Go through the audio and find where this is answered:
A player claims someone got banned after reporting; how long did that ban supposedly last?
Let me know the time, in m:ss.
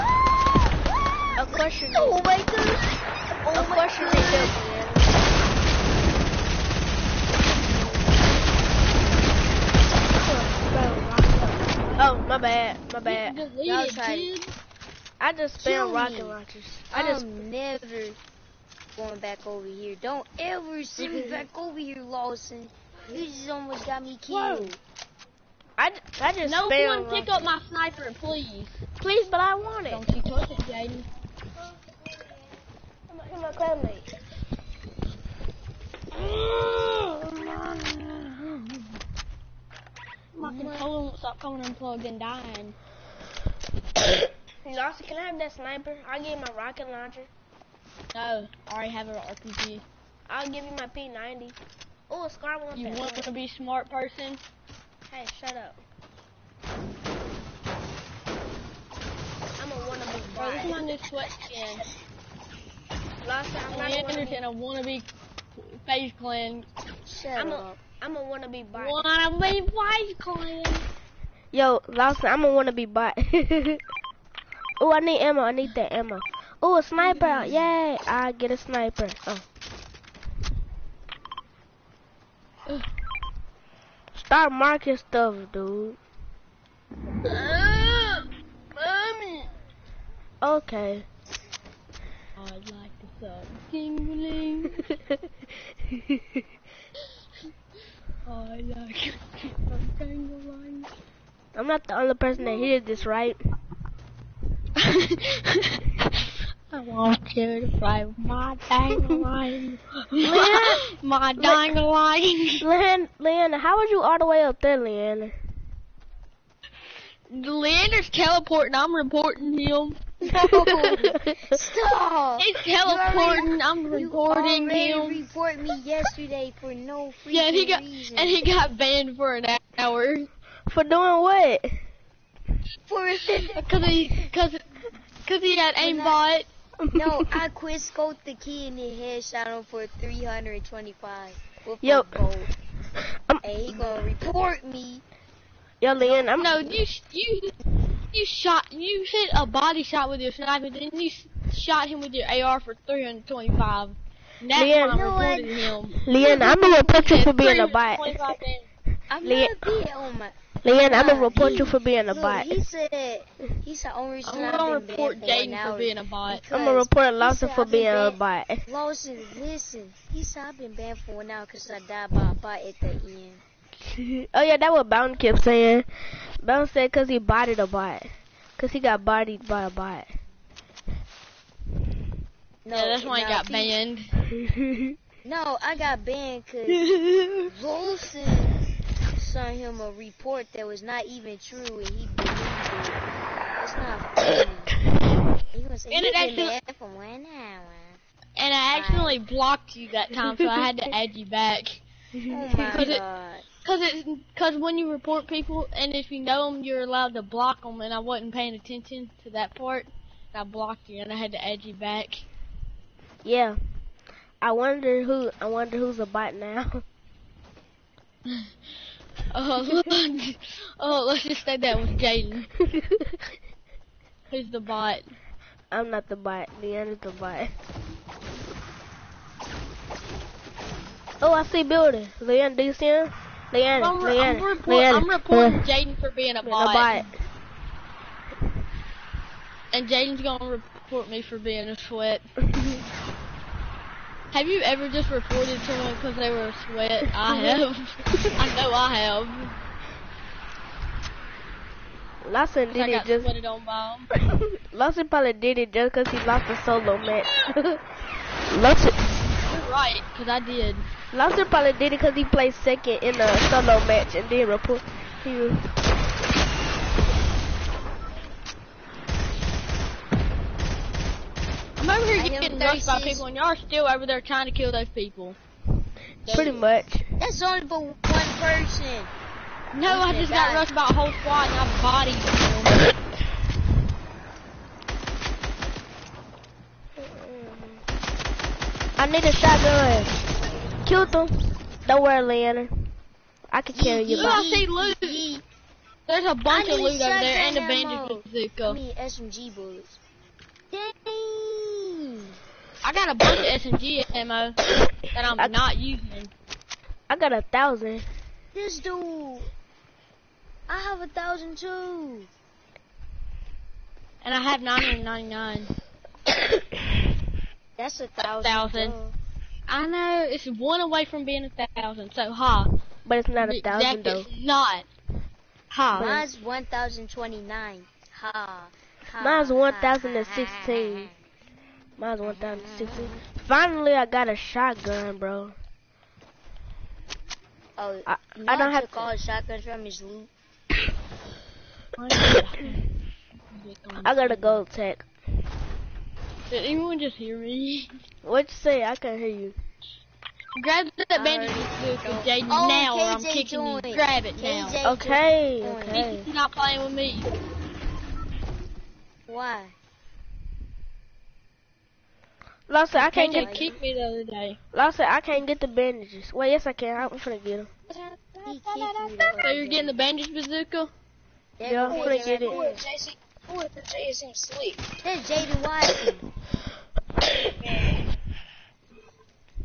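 2:09.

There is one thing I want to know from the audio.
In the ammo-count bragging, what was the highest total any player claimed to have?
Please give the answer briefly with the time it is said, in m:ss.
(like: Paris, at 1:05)
1029, at 5:26.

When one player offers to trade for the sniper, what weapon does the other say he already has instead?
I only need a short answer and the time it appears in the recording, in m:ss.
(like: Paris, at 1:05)
RPG, at 0:49.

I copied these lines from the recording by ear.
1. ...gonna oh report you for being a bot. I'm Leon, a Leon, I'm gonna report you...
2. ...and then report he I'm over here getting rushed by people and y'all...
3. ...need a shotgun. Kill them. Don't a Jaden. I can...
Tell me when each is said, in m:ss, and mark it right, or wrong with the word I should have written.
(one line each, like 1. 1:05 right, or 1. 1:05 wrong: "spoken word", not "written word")
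1. 2:36 right
2. 4:24 right
3. 4:49 wrong: "Leonard", not "Jaden".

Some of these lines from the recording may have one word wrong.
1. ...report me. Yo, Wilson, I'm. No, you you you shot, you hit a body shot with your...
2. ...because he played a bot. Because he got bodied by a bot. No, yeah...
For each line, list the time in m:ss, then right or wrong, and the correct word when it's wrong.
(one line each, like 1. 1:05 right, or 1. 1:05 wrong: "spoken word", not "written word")
1. 2:24 wrong: "Leon", not "Wilson"
2. 2:56 wrong: "bodied", not "played".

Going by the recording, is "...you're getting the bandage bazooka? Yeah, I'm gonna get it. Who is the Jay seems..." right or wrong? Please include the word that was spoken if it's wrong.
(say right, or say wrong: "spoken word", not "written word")
right.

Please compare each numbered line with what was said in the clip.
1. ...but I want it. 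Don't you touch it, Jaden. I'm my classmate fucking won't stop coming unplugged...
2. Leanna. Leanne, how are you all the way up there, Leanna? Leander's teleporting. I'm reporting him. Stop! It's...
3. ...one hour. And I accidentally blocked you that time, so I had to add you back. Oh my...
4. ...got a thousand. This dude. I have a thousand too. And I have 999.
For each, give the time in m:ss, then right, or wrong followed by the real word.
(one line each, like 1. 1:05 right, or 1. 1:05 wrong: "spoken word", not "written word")
1. 0:29 right
2. 1:52 right
3. 3:16 right
4. 5:07 right.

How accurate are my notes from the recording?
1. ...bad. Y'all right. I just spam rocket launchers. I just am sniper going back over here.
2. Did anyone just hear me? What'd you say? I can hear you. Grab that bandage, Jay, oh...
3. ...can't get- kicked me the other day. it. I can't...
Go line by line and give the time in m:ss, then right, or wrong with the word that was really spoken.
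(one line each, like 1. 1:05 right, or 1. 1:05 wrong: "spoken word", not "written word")
1. 0:12 wrong: "never", not "sniper"
2. 5:46 right
3. 6:03 right.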